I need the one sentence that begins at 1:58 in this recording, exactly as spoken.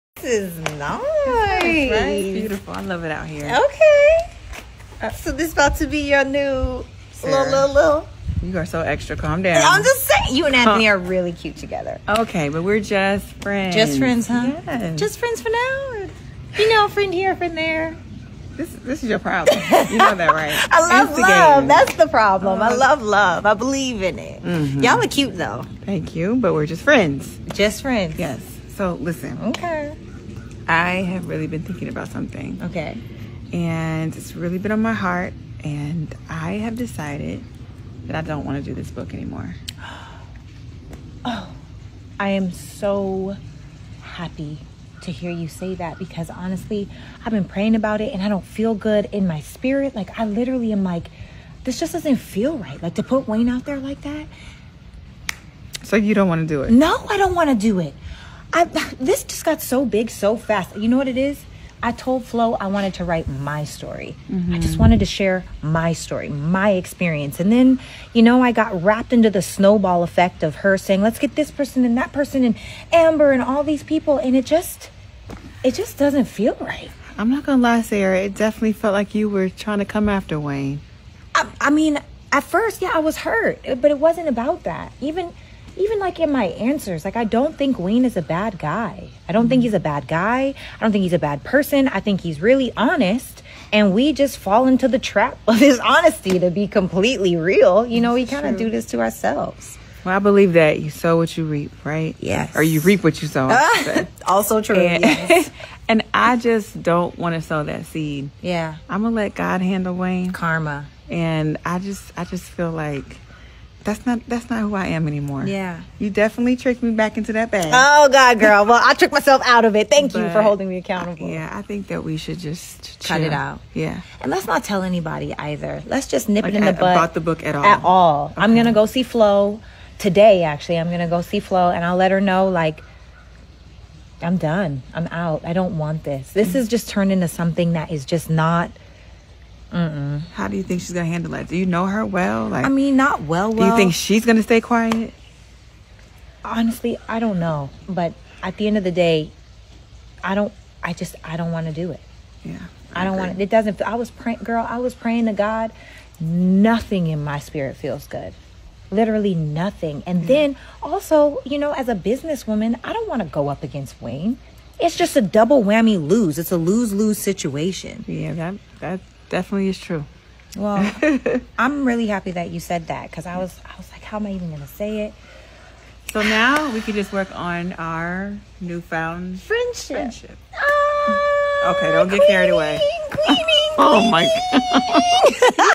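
well, I tricked myself out of it.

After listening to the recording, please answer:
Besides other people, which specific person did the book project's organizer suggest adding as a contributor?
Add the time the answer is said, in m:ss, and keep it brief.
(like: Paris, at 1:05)
Amber, at 1:12.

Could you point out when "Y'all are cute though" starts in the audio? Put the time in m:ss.
0:24.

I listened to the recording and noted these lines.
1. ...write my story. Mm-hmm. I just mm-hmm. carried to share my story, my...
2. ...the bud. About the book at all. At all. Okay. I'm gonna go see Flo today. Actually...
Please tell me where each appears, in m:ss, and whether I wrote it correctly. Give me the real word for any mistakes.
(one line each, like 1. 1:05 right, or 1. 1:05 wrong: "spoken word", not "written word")
1. 1:03 wrong: "wanted", not "carried"
2. 2:06 right.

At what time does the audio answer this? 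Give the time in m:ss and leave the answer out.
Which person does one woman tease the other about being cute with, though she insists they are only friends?
0:10.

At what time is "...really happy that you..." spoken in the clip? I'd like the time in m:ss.
2:51.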